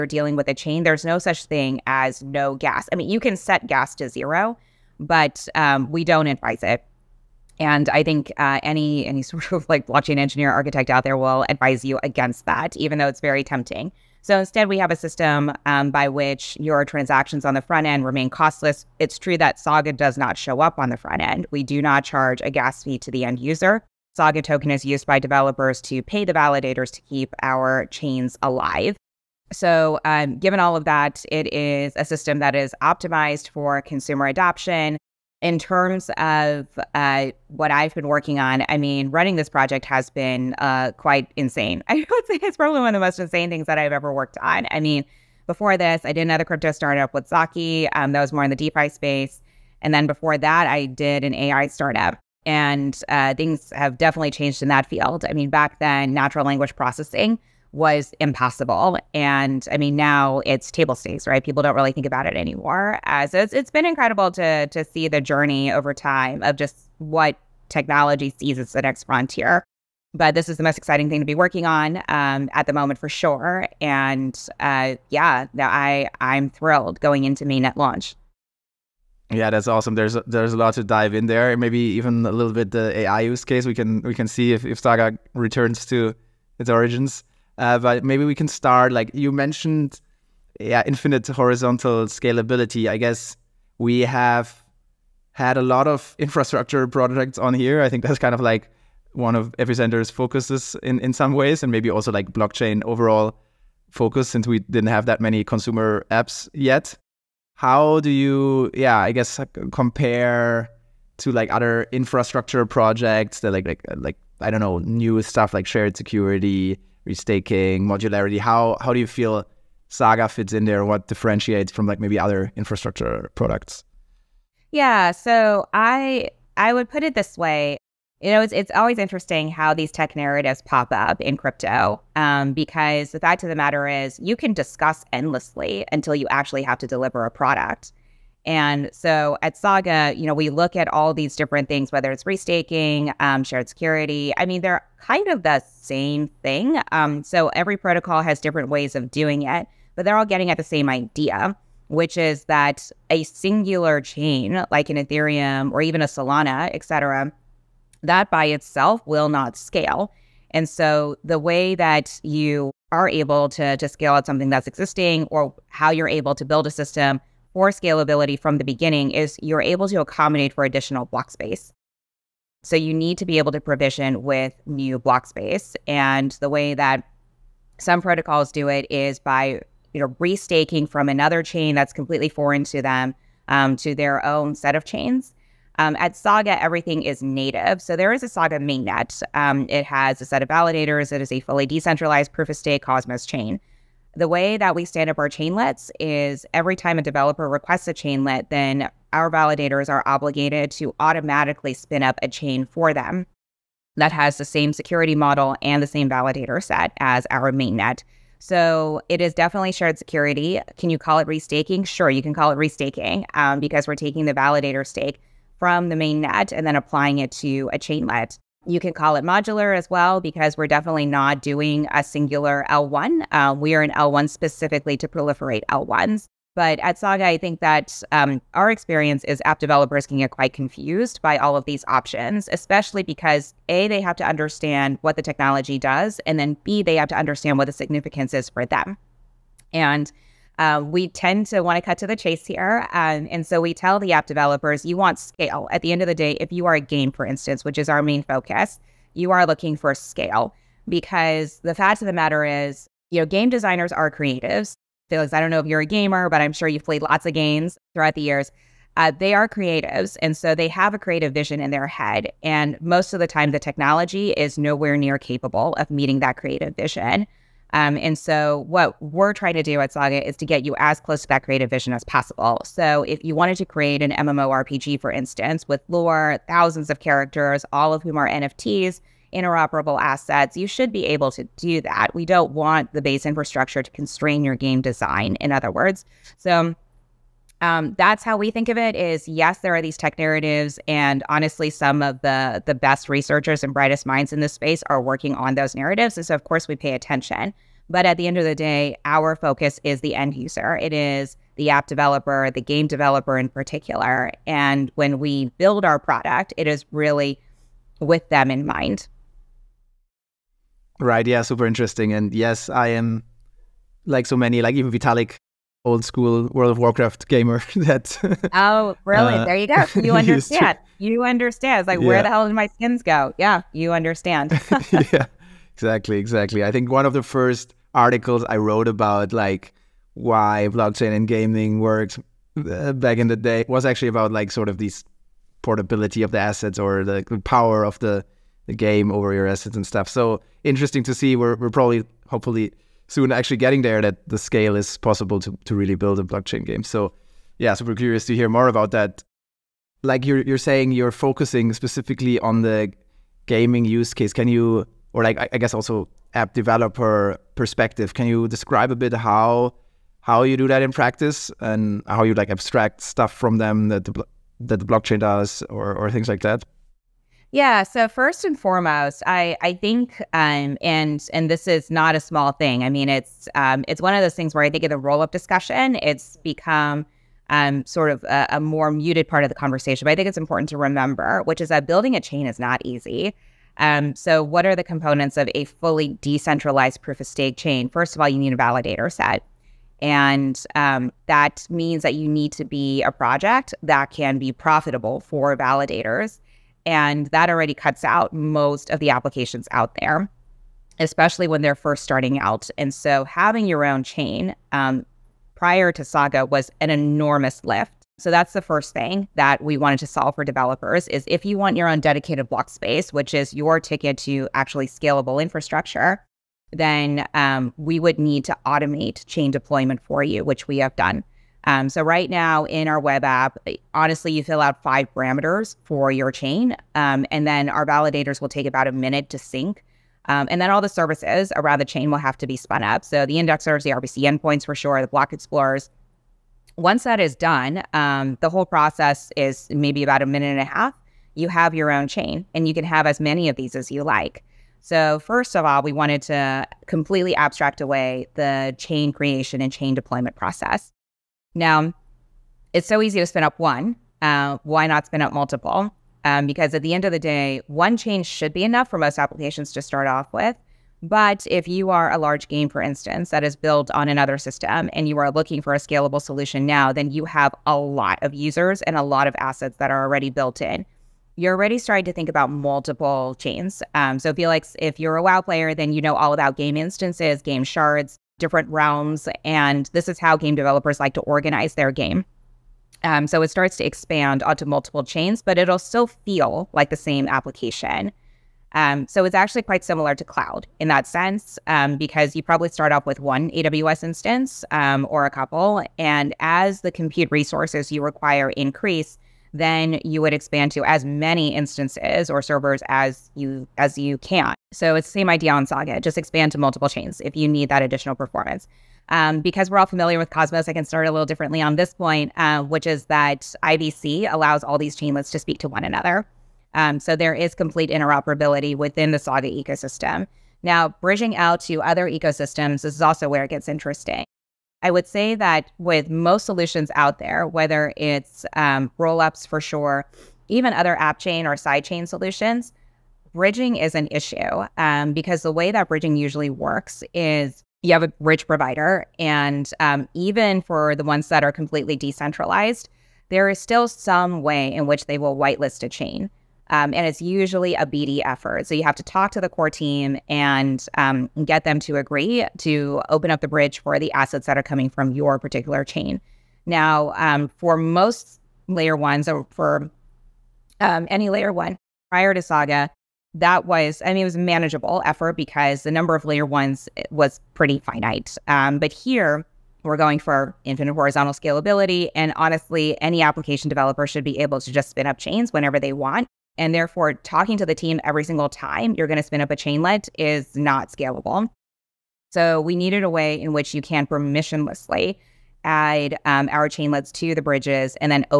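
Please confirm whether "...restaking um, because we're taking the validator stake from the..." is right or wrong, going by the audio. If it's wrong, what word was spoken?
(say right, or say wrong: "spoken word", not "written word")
right.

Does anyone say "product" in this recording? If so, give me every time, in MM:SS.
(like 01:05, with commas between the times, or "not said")
02:03, 02:17, 05:05.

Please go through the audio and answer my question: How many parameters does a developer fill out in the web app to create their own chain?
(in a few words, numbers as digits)
5.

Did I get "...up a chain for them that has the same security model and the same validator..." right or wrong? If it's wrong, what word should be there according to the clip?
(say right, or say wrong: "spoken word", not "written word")
right.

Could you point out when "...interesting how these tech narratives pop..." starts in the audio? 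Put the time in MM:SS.
02:08.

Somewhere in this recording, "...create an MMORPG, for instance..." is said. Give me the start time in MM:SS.
04:33.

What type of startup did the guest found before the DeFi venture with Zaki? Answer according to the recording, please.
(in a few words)
AI startup.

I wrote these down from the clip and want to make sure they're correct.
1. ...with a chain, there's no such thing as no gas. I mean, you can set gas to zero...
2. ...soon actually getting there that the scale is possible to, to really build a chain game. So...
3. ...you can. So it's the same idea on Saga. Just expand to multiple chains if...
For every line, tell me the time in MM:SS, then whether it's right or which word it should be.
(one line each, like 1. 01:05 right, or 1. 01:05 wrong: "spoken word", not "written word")
1. 00:00 right
2. 05:43 wrong: "blockchain", not "chain"
3. 08:23 right.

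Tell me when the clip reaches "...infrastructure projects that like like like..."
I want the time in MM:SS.
01:51.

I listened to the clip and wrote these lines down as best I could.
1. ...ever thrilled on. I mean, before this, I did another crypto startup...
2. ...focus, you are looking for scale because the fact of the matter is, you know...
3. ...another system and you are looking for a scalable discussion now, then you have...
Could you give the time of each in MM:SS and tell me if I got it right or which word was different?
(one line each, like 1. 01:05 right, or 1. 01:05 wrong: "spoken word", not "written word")
1. 00:43 wrong: "worked", not "thrilled"
2. 04:08 right
3. 07:44 wrong: "solution", not "discussion".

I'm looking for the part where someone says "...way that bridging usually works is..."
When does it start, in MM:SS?
08:55.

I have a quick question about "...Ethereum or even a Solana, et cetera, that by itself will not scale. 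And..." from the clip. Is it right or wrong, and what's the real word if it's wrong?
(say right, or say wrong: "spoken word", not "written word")
right.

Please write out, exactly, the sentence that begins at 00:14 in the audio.
So instead, we have a system um, by which your transactions on the front end remain costless.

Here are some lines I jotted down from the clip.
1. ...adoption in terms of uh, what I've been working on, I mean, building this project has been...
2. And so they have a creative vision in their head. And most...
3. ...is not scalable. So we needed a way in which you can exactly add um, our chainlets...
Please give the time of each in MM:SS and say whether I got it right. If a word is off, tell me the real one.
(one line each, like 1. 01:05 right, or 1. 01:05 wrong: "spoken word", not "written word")
1. 00:34 wrong: "running", not "building"
2. 04:20 right
3. 09:40 wrong: "permissionlessly", not "exactly".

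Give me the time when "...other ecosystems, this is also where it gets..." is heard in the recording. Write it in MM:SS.
08:41.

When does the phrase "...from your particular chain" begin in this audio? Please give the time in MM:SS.
09:14.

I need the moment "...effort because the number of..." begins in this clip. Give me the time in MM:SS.
09:25.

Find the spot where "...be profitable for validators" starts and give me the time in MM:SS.
06:34.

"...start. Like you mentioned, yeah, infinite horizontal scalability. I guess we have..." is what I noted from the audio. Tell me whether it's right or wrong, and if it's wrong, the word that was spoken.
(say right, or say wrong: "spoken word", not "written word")
right.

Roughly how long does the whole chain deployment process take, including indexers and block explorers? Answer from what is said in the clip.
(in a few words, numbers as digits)
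A minute and a half.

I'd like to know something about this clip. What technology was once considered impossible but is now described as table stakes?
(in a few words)
Natural language processing.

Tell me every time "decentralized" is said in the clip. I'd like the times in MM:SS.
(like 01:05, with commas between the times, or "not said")
03:11, 06:26, 09:01.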